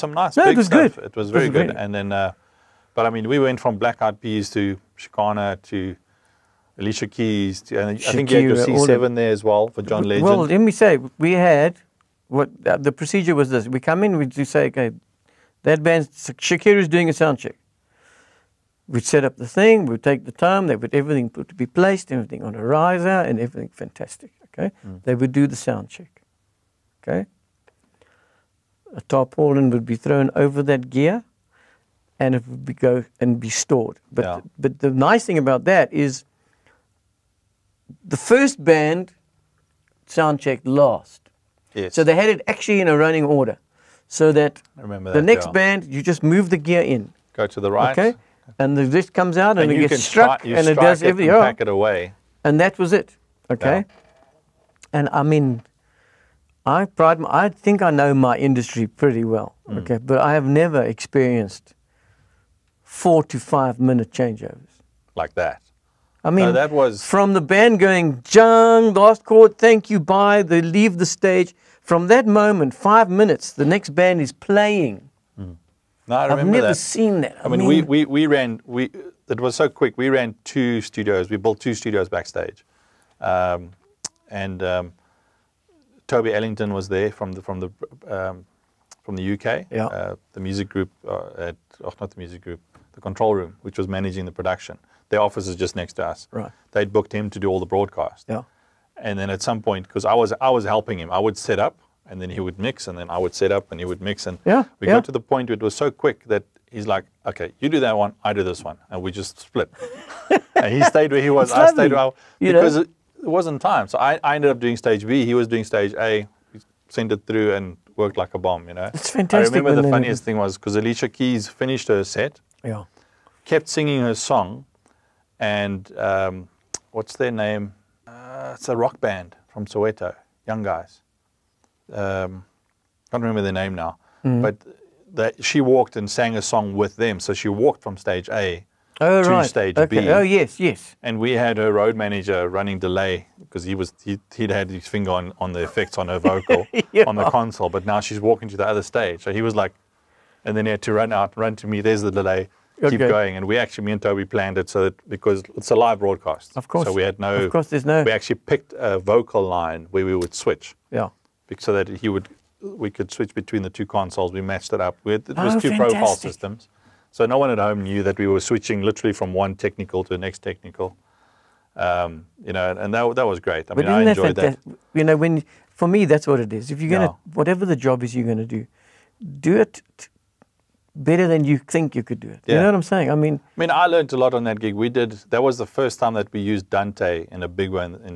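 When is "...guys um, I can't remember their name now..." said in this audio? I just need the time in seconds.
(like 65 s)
130 s.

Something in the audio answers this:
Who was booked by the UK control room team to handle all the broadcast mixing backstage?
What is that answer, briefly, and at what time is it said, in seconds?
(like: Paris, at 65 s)
Toby Ellington, at 86 s.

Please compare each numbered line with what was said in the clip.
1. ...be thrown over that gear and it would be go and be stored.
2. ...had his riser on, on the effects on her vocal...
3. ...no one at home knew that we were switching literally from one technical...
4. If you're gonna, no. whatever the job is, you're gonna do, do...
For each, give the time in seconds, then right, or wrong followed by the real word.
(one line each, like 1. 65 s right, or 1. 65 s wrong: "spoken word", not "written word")
1. 29 s right
2. 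144 s wrong: "finger", not "riser"
3. 167 s right
4. 176 s right.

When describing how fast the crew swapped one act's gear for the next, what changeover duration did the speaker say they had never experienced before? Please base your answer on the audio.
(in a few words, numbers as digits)
4 to 5 minutes.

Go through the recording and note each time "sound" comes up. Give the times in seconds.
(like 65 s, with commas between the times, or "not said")
17 s, 25 s, 40 s.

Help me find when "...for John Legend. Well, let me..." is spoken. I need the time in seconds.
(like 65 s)
9 s.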